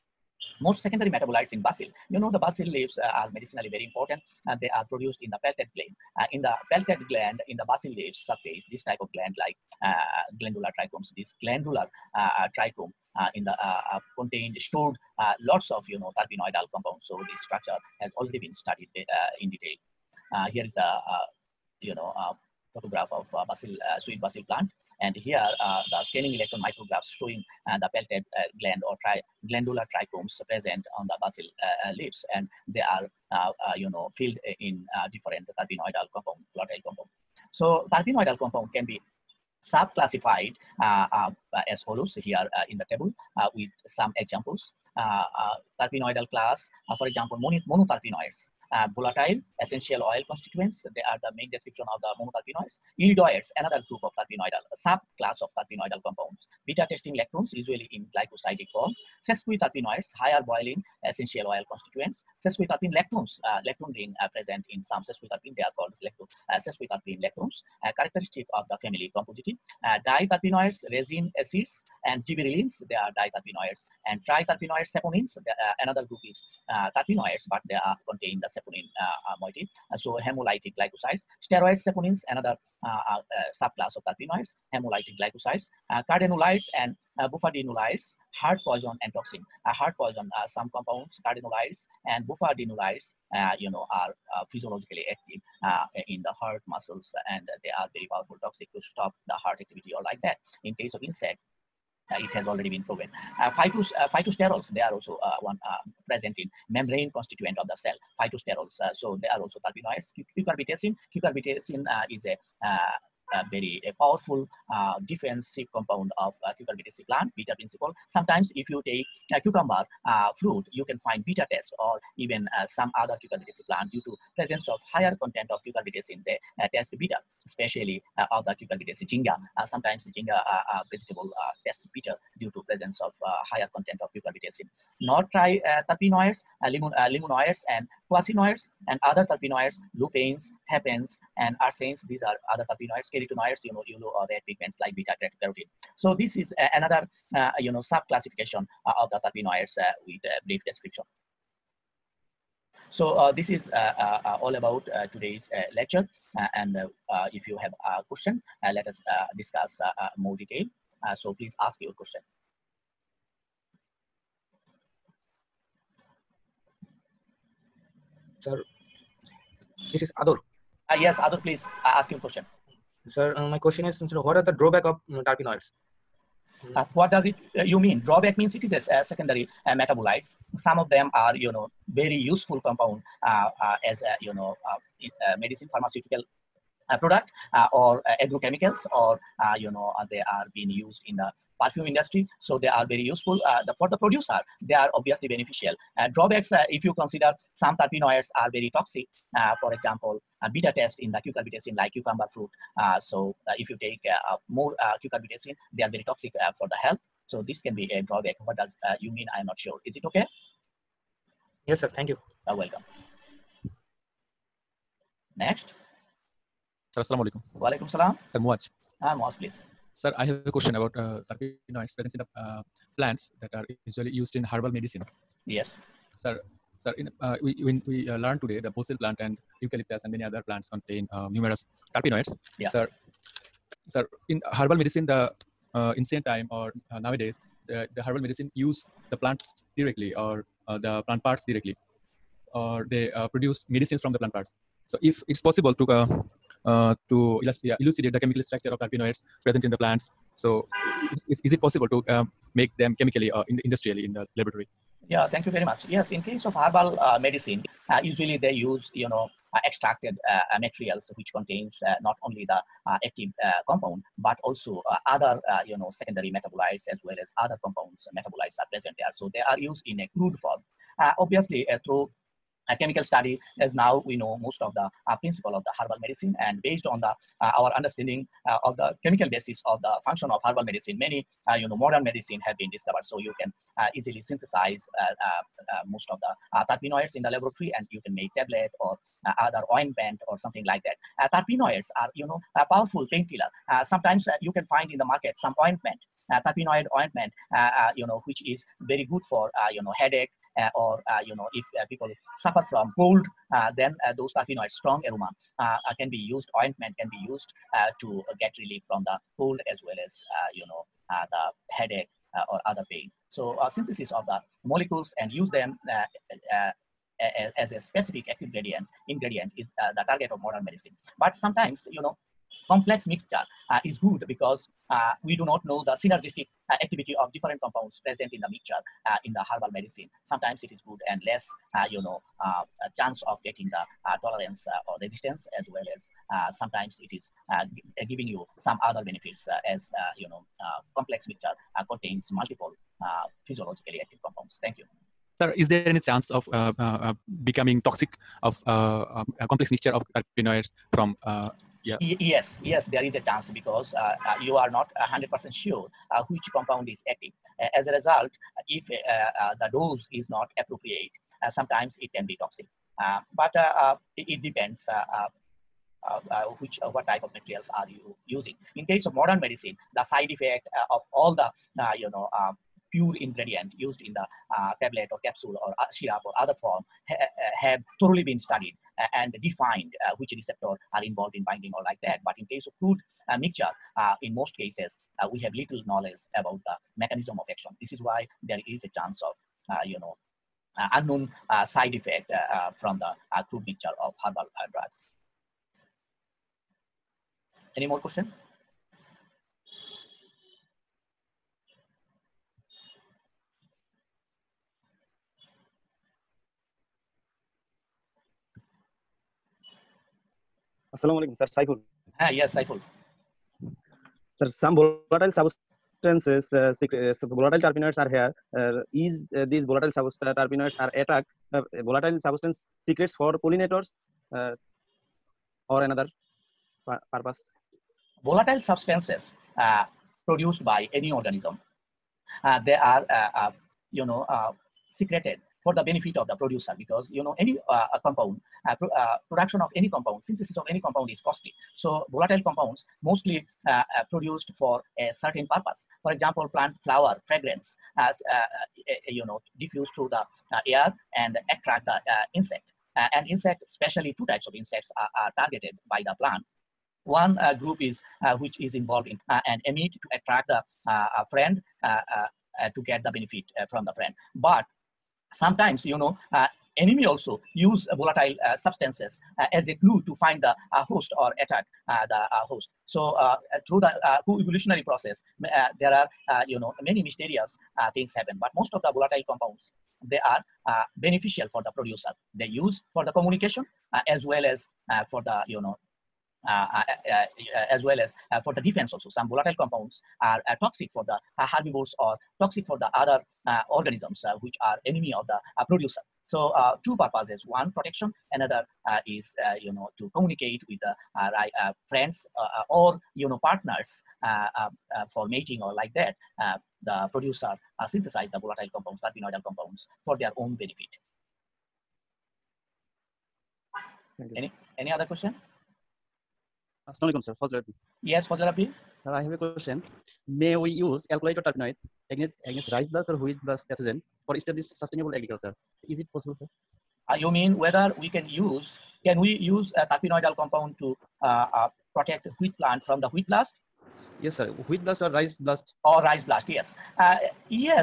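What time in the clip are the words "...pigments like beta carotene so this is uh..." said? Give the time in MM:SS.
02:24.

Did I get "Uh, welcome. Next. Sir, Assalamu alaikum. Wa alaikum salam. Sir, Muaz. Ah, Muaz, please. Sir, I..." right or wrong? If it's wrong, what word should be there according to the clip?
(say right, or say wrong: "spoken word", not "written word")
right.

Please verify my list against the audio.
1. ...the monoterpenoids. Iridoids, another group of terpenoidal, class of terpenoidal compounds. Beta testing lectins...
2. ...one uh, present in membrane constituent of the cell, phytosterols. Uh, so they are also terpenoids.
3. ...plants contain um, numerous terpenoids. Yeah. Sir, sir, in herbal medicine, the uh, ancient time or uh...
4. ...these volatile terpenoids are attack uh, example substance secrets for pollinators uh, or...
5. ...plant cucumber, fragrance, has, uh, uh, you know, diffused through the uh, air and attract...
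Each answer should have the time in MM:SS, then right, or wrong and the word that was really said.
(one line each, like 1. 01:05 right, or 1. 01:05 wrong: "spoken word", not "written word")
1. 00:52 wrong: "subclass", not "class"
2. 01:45 right
3. 03:50 right
4. 06:59 wrong: "volatile", not "example"
5. 07:26 wrong: "flower", not "cucumber".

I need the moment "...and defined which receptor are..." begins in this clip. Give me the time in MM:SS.
06:19.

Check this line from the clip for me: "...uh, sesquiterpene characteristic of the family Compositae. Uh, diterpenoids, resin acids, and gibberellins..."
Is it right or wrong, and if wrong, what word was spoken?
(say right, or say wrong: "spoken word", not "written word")
right.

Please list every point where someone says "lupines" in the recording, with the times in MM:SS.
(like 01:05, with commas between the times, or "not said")
02:19.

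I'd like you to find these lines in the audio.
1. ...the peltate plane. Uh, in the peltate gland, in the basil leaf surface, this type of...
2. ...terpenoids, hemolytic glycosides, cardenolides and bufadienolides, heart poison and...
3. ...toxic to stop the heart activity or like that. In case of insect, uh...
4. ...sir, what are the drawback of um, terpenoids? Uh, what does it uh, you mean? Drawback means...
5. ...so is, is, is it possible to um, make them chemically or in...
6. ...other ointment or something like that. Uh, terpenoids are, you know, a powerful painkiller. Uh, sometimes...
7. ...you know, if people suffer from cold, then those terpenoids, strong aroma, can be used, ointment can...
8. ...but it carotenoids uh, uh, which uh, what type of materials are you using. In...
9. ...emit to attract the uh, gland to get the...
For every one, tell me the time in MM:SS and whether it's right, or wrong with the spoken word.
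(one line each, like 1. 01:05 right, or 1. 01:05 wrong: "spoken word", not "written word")
1. 00:05 right
2. 01:24 right
3. 01:38 right
4. 02:53 right
5. 04:10 right
6. 04:49 right
7. 05:01 right
8. 06:03 wrong: "depends", not "carotenoids"
9. 07:39 wrong: "friend", not "gland".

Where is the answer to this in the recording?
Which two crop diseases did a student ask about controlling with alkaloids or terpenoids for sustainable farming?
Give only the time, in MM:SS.
08:42.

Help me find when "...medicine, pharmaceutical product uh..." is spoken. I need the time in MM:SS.
03:05.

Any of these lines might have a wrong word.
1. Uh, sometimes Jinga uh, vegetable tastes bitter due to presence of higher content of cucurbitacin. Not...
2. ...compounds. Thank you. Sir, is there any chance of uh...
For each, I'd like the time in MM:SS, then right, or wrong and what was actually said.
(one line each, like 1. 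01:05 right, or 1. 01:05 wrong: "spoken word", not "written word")
1. 02:09 right
2. 05:44 right.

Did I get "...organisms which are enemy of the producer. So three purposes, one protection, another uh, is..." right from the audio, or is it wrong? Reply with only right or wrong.
wrong.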